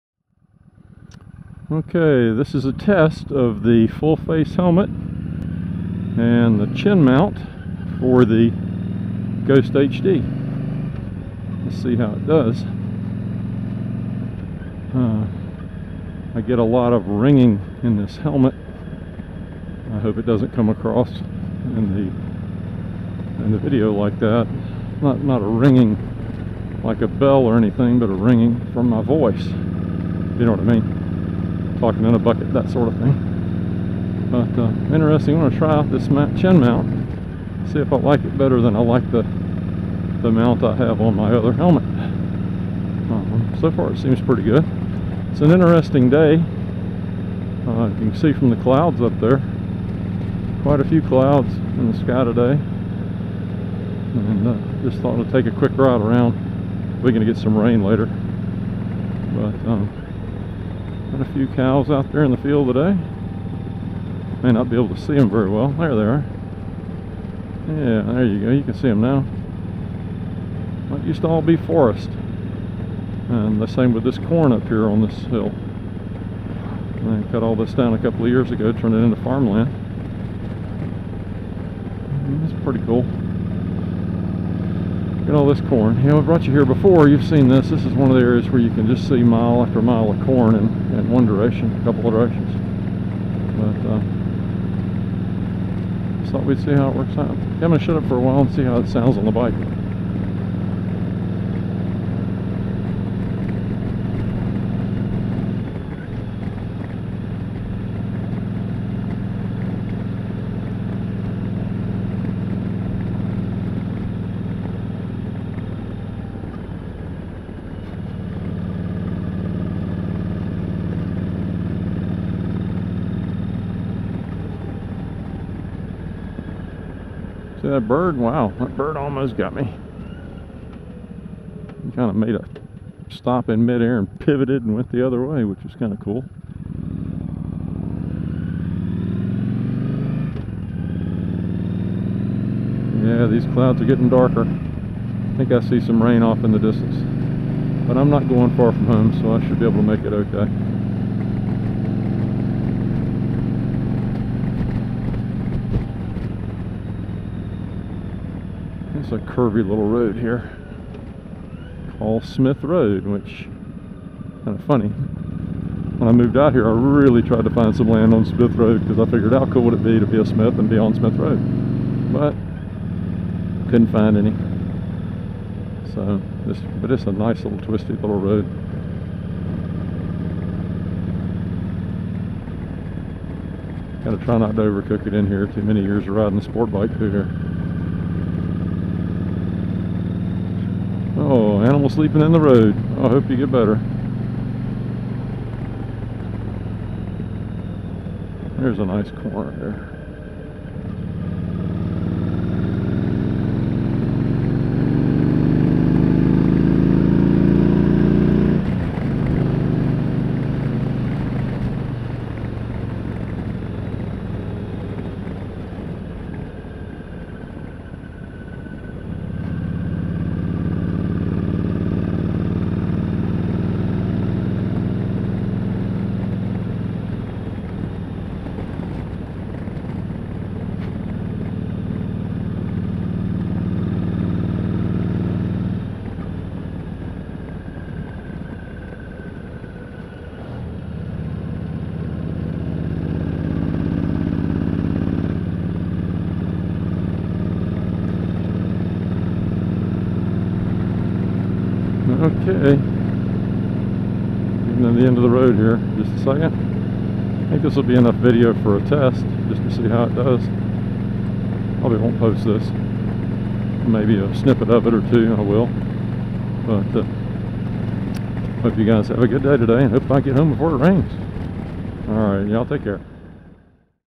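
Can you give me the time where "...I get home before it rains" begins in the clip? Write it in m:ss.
4:30.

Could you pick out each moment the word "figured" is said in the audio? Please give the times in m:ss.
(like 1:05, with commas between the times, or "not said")
2:49.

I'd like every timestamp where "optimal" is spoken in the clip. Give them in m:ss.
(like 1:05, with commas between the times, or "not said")
not said.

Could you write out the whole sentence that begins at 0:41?
Um, so far it seems pretty good.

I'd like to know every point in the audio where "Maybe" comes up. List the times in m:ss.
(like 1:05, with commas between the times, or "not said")
4:23.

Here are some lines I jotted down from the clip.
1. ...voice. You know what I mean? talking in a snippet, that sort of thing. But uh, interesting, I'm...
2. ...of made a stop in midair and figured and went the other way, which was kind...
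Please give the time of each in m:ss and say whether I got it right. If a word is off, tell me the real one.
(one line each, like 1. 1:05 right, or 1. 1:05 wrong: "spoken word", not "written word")
1. 0:29 wrong: "bucket", not "snippet"
2. 2:12 wrong: "pivoted", not "figured".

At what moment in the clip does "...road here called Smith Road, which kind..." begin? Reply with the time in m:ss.
2:39.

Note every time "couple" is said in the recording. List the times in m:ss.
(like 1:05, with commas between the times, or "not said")
1:17, 1:31.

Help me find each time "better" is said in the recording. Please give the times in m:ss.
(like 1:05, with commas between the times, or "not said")
0:38, 3:13.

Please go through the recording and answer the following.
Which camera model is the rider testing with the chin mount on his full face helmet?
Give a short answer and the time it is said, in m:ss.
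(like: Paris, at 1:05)
Ghost HD, at 0:09.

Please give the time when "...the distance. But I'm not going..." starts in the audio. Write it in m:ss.
2:26.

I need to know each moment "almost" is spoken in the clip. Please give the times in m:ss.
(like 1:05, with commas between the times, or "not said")
2:08, 3:11.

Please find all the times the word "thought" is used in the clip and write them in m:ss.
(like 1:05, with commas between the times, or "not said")
0:55, 1:36.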